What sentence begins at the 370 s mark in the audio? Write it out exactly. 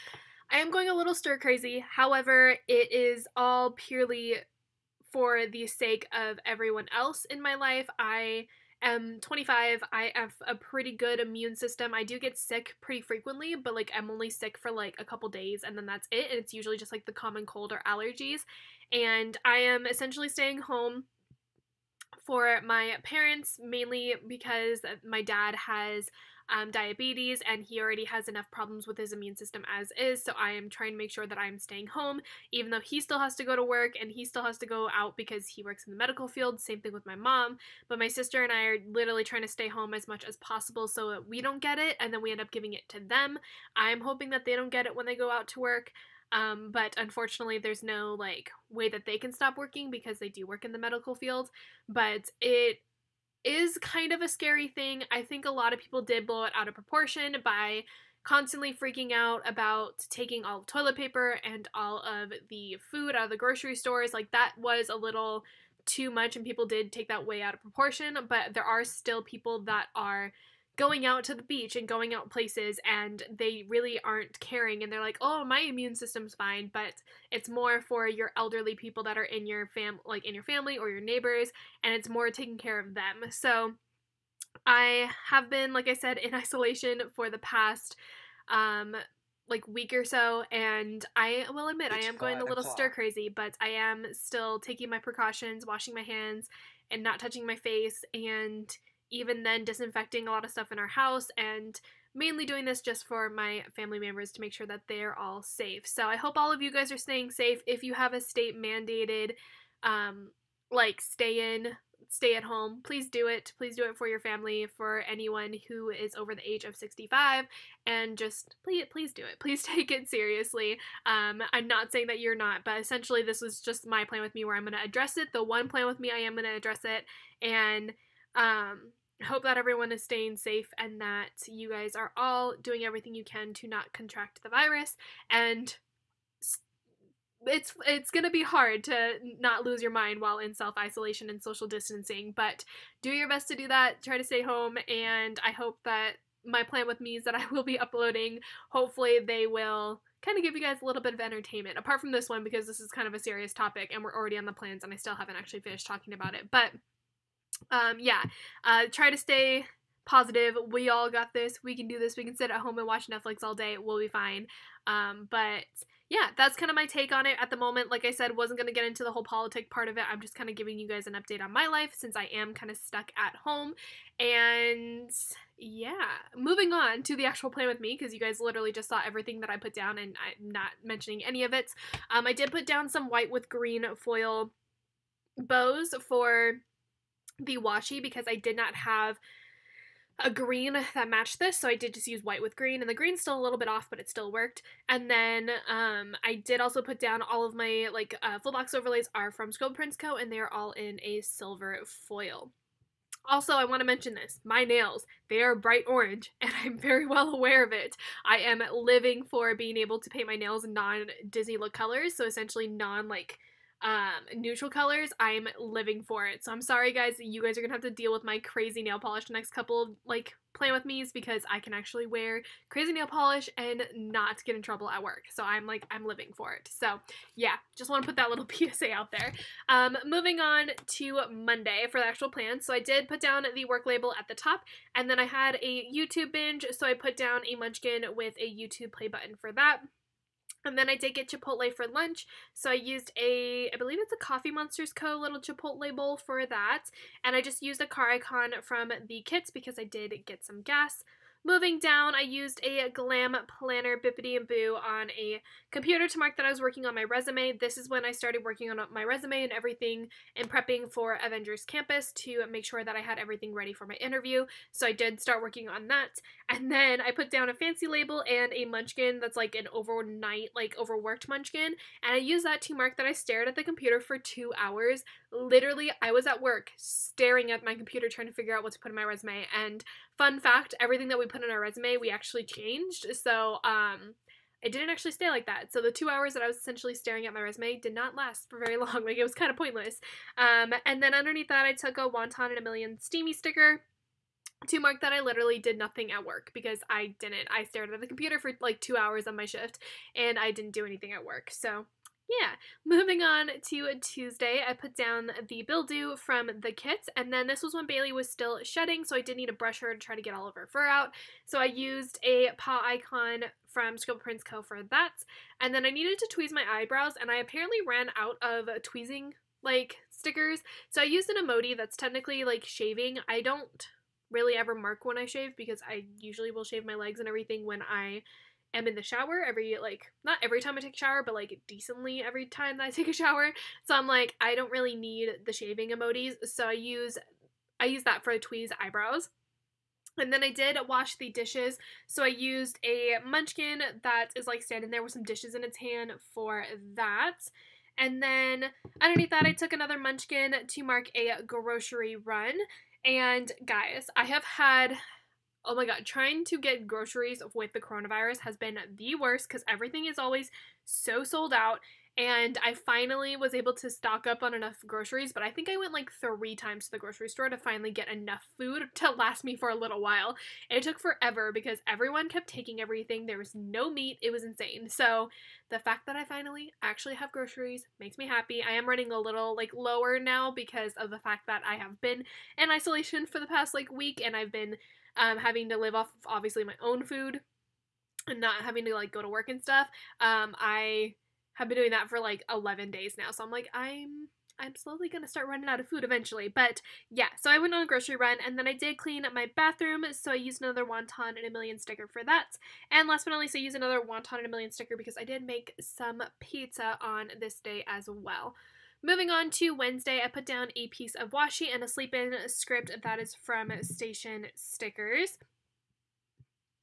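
It took forever because everyone kept taking everything.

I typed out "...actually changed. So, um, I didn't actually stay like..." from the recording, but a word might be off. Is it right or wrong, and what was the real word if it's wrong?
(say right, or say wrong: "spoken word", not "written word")
right.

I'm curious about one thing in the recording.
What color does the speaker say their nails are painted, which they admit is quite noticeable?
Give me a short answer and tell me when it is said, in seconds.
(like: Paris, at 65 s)
Bright orange, at 205 s.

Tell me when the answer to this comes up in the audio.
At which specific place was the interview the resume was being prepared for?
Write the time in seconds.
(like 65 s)
261 s.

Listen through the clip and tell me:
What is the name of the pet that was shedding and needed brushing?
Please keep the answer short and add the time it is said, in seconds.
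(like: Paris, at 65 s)
Bailey, at 307 s.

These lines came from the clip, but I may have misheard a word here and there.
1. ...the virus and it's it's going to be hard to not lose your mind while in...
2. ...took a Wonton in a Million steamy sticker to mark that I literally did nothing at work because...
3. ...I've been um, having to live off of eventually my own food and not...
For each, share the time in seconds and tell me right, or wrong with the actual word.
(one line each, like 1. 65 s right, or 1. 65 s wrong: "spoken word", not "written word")
1. 134 s right
2. 291 s right
3. 384 s wrong: "obviously", not "eventually".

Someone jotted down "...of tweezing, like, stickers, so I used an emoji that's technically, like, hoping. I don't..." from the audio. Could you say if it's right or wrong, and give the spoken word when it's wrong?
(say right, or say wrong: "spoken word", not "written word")
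wrong: "shaving", not "hoping".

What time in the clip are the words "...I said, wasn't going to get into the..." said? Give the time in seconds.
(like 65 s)
168 s.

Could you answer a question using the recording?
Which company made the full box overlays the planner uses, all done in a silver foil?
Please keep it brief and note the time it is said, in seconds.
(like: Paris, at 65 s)
Scope Prints Co., at 199 s.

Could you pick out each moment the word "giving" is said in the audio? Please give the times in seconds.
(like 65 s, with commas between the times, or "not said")
42 s, 170 s.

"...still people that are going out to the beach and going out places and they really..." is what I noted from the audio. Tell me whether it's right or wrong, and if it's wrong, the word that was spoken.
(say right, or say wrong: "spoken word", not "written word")
right.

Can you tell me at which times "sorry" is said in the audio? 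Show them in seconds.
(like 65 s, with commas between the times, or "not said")
216 s.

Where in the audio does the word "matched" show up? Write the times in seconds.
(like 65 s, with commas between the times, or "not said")
191 s.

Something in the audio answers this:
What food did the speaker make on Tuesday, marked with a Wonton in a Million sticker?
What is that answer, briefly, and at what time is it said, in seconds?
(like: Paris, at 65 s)
Pizza, at 406 s.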